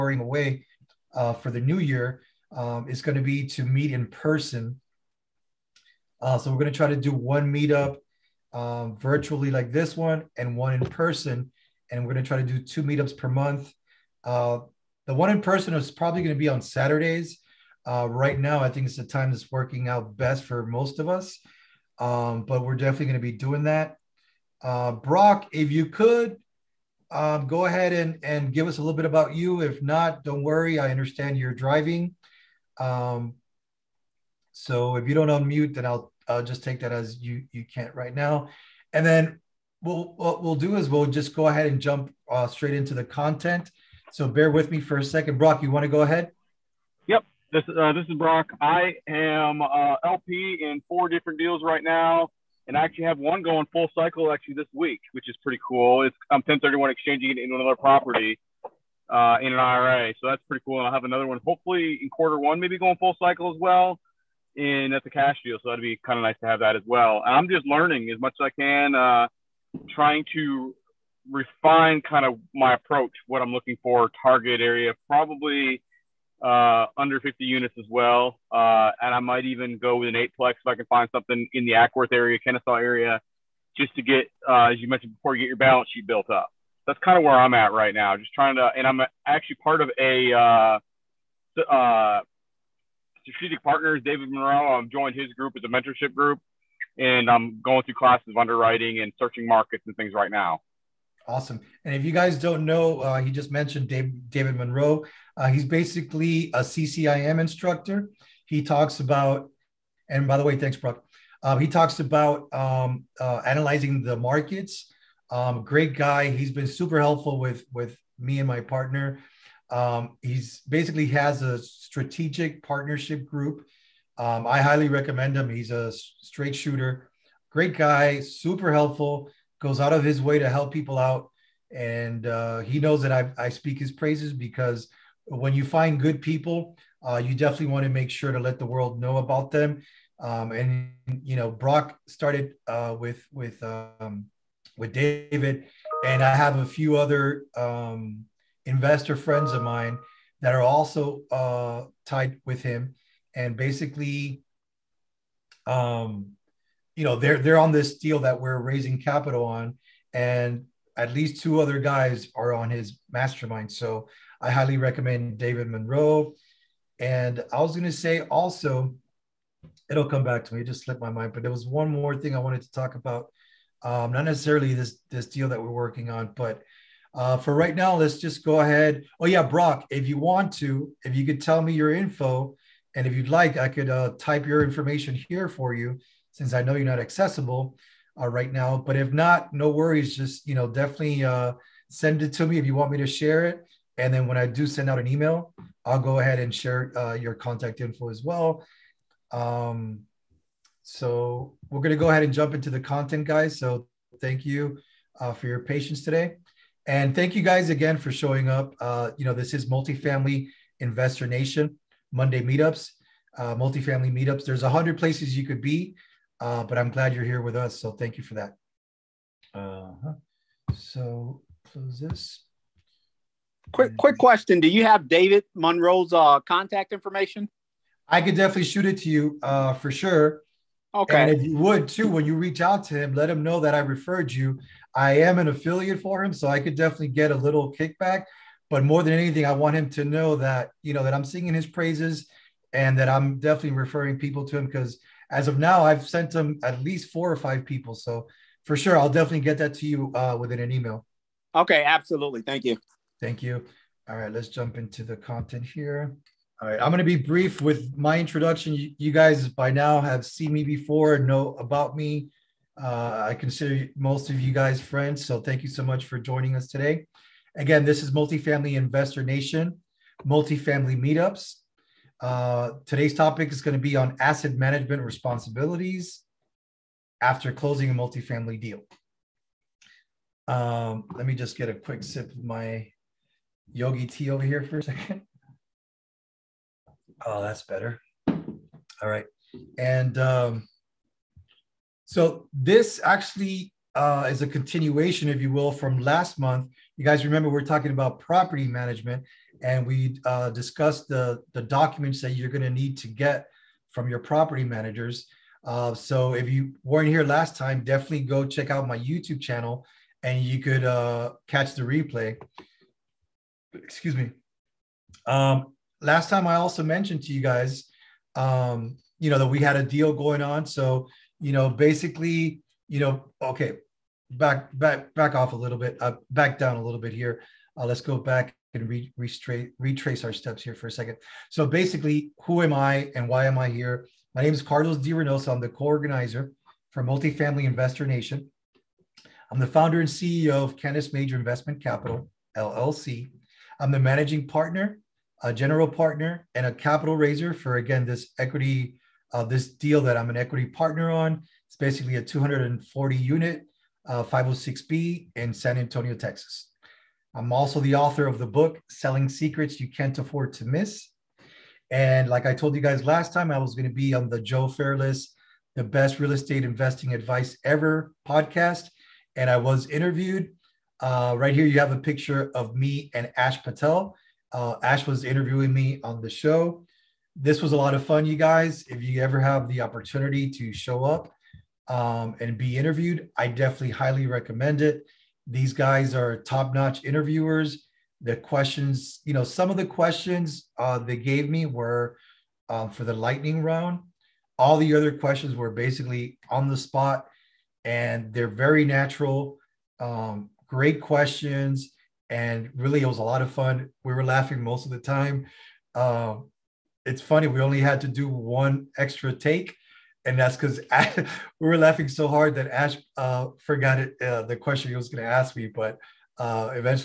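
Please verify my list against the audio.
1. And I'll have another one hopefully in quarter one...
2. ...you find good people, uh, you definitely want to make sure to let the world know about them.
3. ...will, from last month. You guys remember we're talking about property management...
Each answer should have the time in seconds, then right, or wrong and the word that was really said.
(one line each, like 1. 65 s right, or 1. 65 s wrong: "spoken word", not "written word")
1. 60 s right
2. 135 s right
3. 295 s right.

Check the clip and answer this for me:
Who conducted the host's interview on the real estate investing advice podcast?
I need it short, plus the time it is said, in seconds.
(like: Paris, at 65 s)
Ash Patel, at 373 s.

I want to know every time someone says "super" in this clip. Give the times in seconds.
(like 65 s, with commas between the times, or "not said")
116 s, 128 s.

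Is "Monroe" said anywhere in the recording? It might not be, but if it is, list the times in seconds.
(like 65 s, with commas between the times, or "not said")
94 s, 104 s, 165 s, 225 s.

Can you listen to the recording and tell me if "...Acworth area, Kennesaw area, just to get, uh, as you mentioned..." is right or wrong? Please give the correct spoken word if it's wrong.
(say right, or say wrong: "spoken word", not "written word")
right.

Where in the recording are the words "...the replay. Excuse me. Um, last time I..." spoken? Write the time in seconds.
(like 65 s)
311 s.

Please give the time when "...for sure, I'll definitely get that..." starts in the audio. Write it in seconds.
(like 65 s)
248 s.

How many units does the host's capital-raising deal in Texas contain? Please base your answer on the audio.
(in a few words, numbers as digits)
240.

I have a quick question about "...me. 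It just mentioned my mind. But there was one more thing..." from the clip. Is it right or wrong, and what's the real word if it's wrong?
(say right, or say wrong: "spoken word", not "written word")
wrong: "slipped", not "mentioned".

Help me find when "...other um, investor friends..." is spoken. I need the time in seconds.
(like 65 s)
146 s.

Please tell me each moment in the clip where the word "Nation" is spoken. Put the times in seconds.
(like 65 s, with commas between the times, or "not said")
211 s, 269 s, 338 s.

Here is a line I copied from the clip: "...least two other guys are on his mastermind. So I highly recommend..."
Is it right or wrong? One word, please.
right.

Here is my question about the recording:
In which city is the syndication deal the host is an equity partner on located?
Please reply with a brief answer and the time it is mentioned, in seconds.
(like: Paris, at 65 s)
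San Antonio, at 355 s.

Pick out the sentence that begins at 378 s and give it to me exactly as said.
If you ever have the opportunity to show up um, and be interviewed, I definitely highly recommend it.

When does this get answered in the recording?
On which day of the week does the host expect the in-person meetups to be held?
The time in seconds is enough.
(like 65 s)
16 s.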